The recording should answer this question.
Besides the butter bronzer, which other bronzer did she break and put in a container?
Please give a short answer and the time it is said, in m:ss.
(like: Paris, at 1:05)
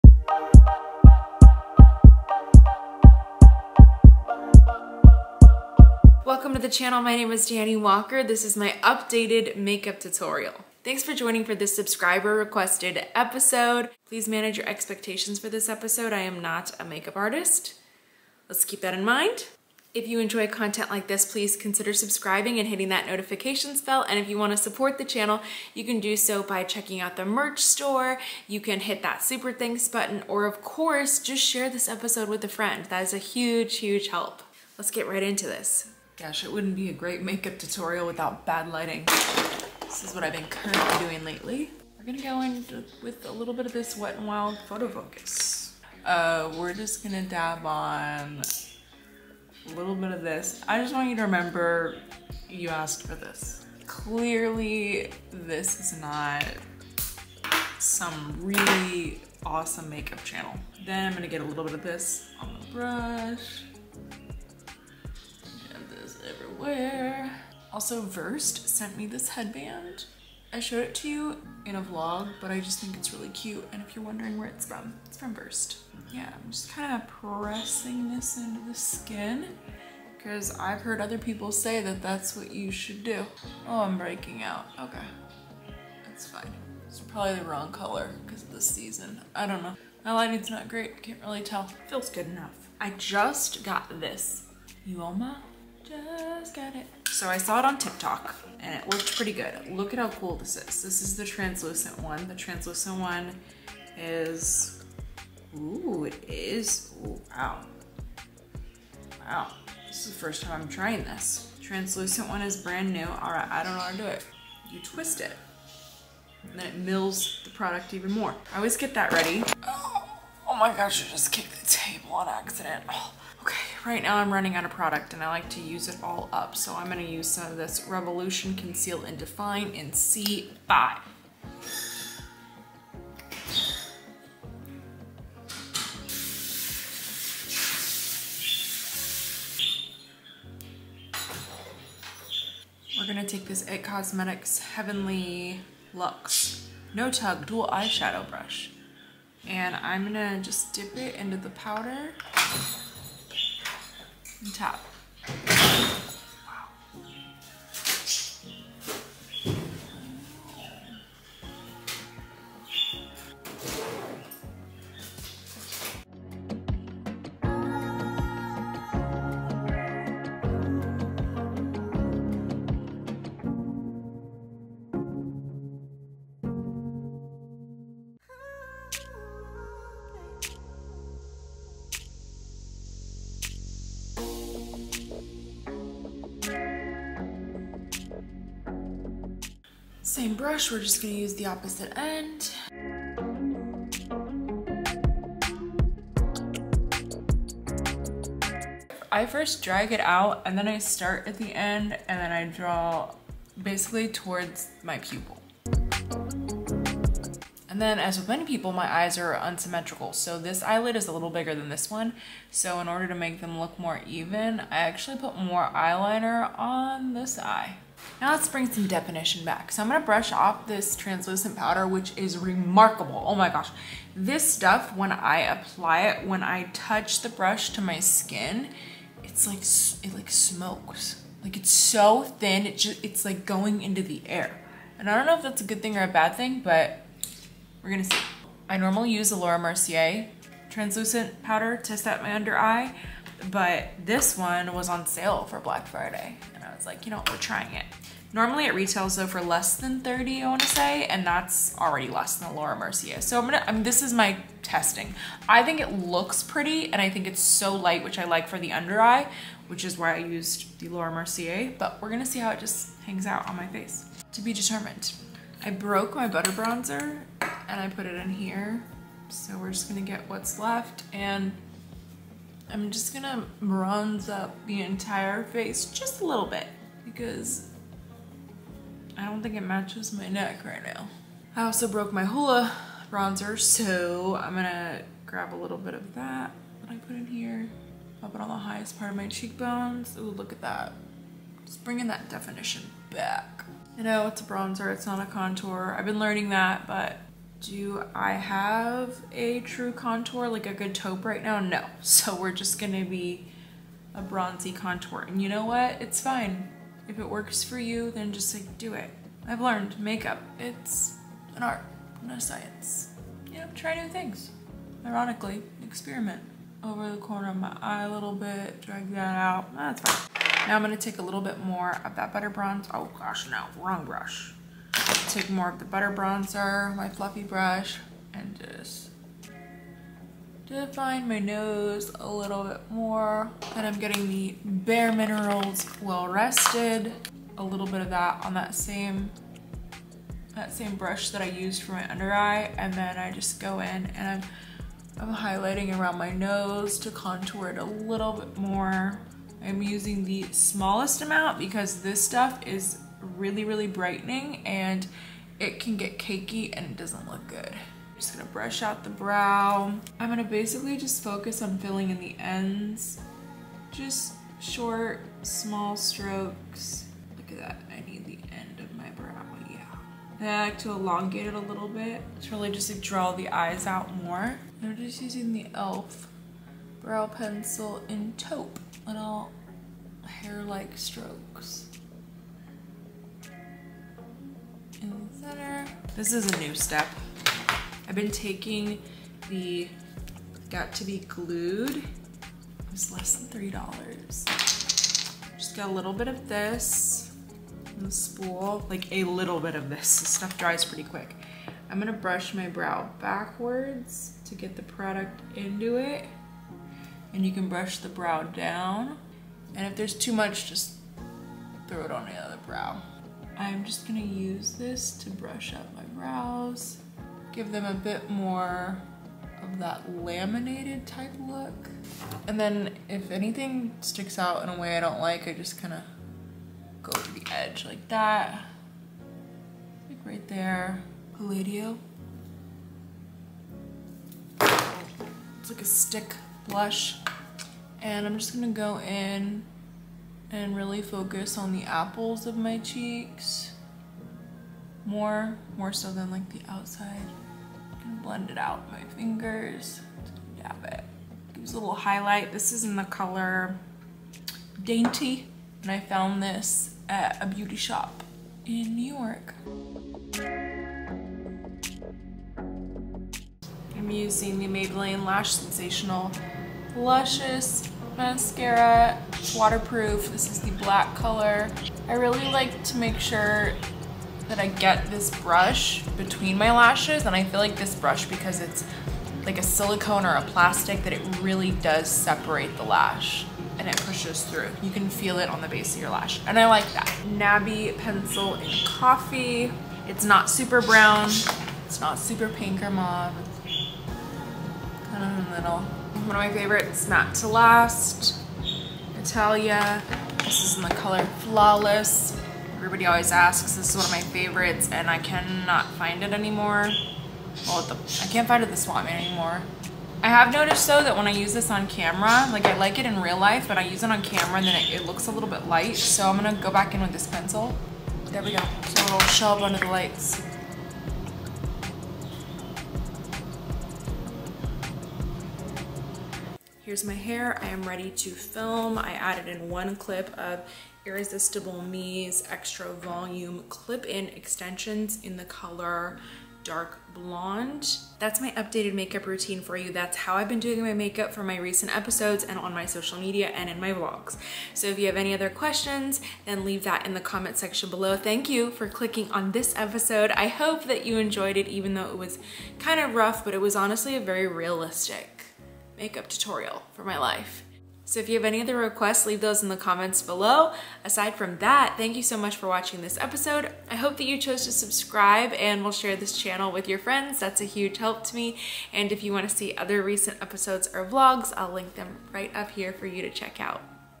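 Hoola, at 4:42.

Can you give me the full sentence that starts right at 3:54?
And I don't know if that's a good thing or a bad thing, but we're gonna see.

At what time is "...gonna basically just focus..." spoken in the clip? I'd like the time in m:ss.
6:00.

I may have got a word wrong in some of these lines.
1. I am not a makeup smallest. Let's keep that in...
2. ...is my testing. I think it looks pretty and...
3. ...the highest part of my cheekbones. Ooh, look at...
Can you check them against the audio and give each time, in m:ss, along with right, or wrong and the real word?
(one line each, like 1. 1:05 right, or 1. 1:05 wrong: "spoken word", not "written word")
1. 0:16 wrong: "artist", not "smallest"
2. 4:14 right
3. 4:48 right.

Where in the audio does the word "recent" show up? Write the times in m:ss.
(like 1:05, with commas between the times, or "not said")
9:01, 9:30.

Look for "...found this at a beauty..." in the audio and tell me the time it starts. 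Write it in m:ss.
7:35.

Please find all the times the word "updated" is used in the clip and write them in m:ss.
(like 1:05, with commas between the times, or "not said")
0:08, 8:58.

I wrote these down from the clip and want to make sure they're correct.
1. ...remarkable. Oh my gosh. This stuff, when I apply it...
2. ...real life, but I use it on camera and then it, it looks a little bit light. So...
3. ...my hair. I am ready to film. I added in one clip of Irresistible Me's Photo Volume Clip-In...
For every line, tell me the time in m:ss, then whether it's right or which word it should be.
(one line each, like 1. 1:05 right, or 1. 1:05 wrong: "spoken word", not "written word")
1. 3:42 right
2. 8:33 right
3. 8:47 wrong: "Extra", not "Photo".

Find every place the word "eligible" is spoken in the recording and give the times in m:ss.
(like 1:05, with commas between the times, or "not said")
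not said.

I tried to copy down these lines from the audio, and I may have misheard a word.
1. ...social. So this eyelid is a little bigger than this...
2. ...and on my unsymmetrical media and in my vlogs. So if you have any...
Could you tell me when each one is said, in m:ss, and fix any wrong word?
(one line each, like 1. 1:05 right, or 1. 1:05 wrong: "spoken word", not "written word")
1. 3:29 wrong: "unsymmetrical", not "social"
2. 9:02 wrong: "social", not "unsymmetrical".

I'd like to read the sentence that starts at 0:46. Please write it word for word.
Uh, we're just gonna dab on a little bit of this.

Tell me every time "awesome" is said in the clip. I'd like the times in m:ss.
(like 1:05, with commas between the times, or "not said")
0:59.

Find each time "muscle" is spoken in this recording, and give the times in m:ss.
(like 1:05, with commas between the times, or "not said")
not said.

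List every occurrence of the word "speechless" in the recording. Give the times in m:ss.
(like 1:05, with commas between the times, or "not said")
not said.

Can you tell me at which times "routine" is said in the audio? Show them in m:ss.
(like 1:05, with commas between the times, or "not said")
8:59.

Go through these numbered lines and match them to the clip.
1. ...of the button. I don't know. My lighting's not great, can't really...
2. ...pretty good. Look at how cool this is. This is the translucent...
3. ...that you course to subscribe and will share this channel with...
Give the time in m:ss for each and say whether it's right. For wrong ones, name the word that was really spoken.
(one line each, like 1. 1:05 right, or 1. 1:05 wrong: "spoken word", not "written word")
1. 1:28 wrong: "season", not "button"
2. 1:39 right
3. 9:24 wrong: "chose", not "course".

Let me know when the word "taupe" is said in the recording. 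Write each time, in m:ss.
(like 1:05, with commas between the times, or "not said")
5:00, 6:18.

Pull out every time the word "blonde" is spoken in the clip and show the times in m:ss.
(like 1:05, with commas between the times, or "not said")
8:57.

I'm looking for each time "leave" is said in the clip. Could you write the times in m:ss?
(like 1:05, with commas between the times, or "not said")
9:06, 9:19.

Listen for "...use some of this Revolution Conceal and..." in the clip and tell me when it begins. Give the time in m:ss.
2:07.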